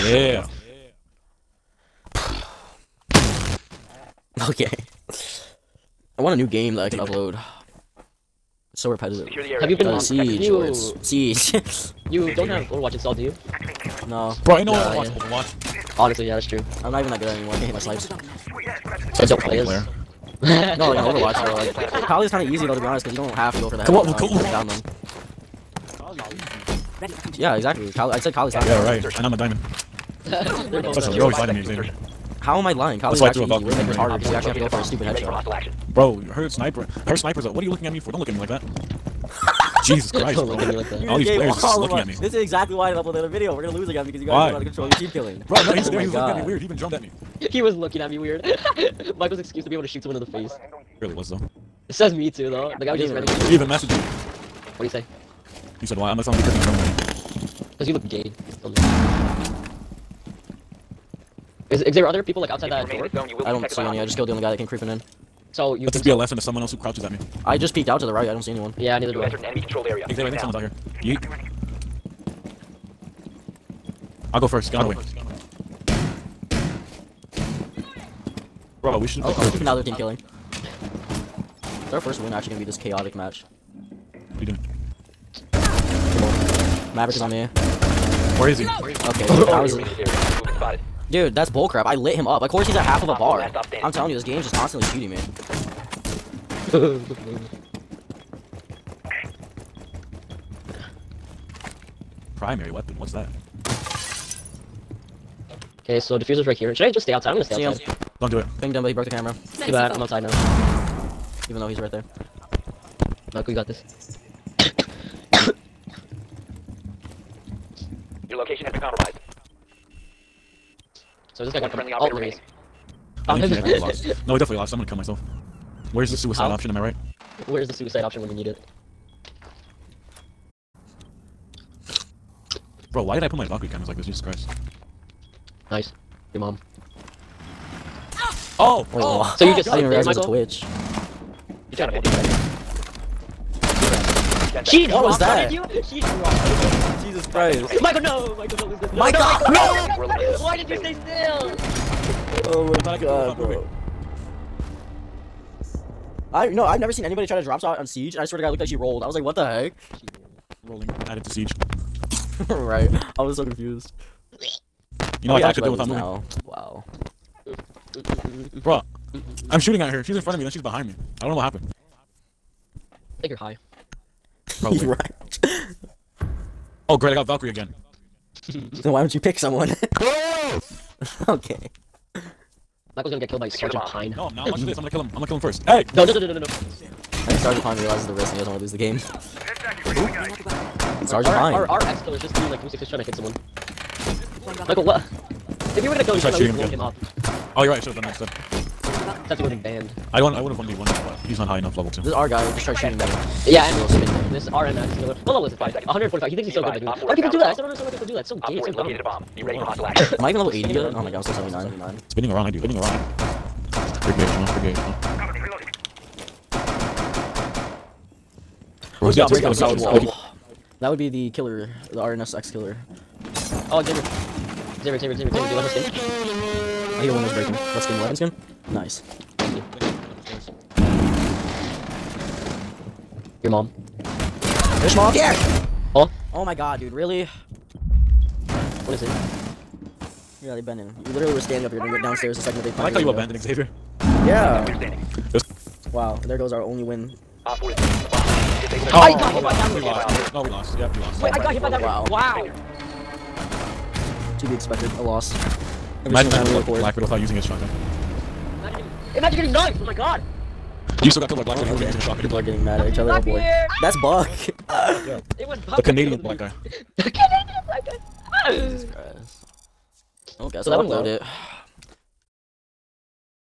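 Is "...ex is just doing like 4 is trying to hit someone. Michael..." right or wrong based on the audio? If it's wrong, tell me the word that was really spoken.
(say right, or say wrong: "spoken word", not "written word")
wrong: "3", not "4".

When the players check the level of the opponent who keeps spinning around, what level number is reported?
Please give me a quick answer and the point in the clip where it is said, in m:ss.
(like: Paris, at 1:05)
145, at 3:25.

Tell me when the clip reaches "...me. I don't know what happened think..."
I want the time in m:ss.
2:50.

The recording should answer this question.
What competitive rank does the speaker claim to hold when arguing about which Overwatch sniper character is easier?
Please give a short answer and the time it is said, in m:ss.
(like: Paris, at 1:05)
Diamond, at 0:29.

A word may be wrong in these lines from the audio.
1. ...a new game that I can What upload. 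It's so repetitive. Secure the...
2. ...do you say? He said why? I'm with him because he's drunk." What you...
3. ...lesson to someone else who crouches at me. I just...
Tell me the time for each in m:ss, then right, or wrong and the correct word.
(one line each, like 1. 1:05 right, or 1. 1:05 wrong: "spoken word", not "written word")
1. 0:06 wrong: "Damn", not "What"
2. 0:54 wrong: "Because", not "What"
3. 1:06 right.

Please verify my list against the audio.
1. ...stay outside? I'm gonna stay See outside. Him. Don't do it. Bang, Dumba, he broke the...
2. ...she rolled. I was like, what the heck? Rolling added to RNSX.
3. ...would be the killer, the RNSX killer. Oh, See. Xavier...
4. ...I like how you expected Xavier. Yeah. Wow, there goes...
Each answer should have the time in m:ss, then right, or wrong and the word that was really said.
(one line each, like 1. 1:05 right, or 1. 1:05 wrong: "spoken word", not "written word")
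1. 1:47 right
2. 2:38 wrong: "Siege", not "RNSX"
3. 3:40 wrong: "Xavier", not "See"
4. 4:02 wrong: "abandoned", not "expected".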